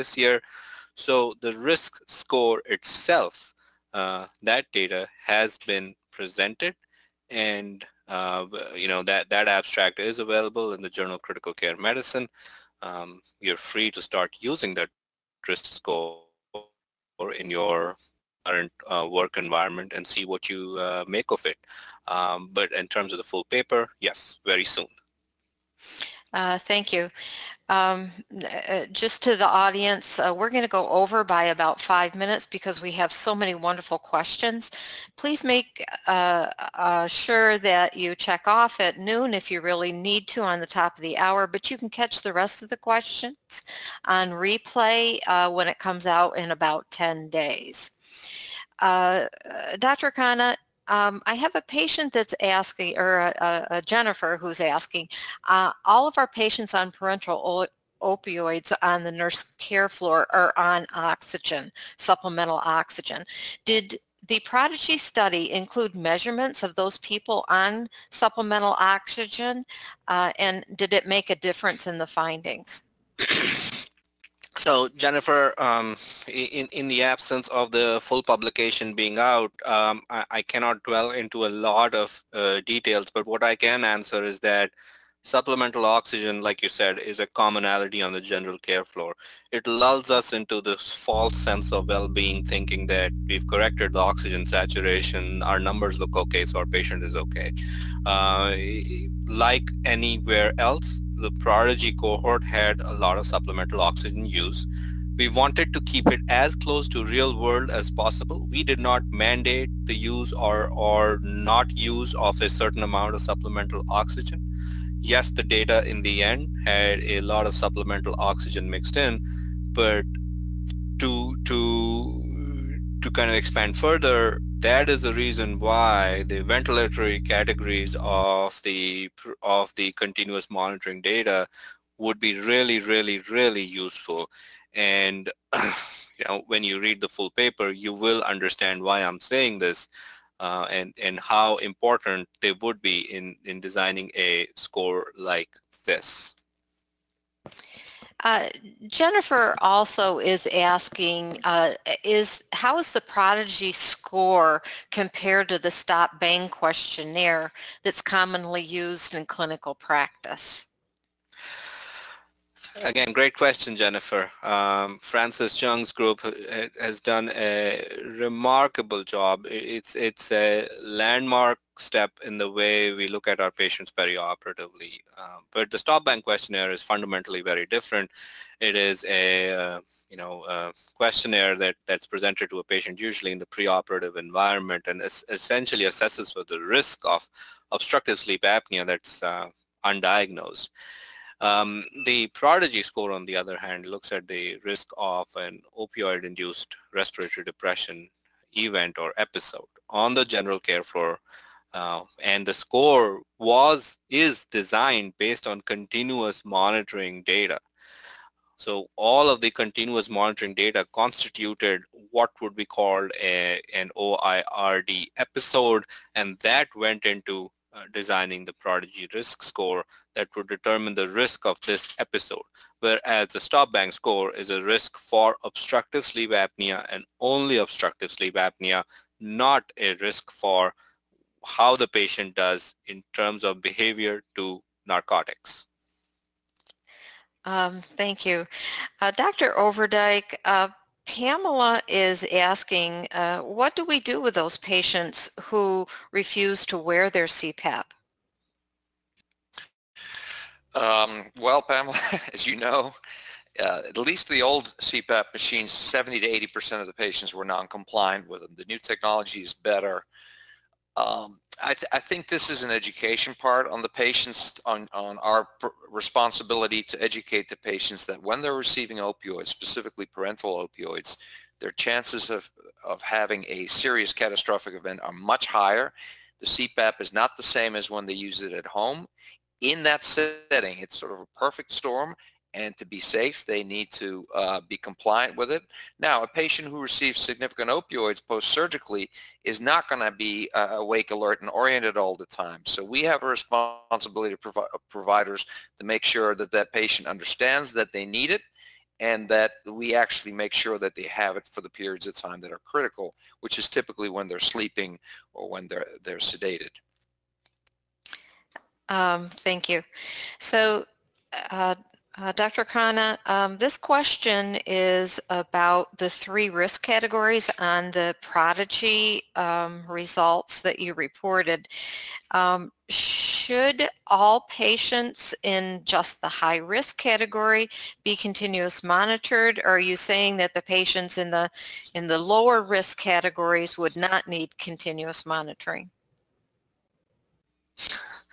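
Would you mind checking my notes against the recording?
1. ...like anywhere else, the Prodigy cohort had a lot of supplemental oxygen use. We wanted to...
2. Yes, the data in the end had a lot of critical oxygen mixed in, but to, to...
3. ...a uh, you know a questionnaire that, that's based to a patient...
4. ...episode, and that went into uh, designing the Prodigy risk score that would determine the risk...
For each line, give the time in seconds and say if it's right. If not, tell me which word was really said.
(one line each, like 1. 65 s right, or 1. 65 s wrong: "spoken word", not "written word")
1. 99 s right
2. 115 s wrong: "supplemental", not "critical"
3. 179 s wrong: "presented", not "based"
4. 215 s right.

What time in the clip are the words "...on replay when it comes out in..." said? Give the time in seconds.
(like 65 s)
44 s.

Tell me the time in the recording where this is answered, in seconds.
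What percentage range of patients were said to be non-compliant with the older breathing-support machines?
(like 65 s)
255 s.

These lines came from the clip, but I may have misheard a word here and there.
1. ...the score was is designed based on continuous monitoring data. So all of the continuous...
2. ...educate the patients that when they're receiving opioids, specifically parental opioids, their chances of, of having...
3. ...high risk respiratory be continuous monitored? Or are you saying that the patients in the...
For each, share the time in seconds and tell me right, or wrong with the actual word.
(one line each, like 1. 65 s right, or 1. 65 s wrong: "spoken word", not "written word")
1. 202 s right
2. 267 s right
3. 326 s wrong: "category", not "respiratory".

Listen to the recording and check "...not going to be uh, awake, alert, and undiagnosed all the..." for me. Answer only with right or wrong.
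wrong.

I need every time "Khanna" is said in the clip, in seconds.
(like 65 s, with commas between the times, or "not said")
50 s, 312 s.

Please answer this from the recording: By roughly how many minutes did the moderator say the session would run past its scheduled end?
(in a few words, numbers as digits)
5.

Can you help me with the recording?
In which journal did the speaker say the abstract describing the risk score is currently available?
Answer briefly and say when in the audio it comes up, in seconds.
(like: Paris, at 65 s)
Journal of Critical Care Medicine, at 10 s.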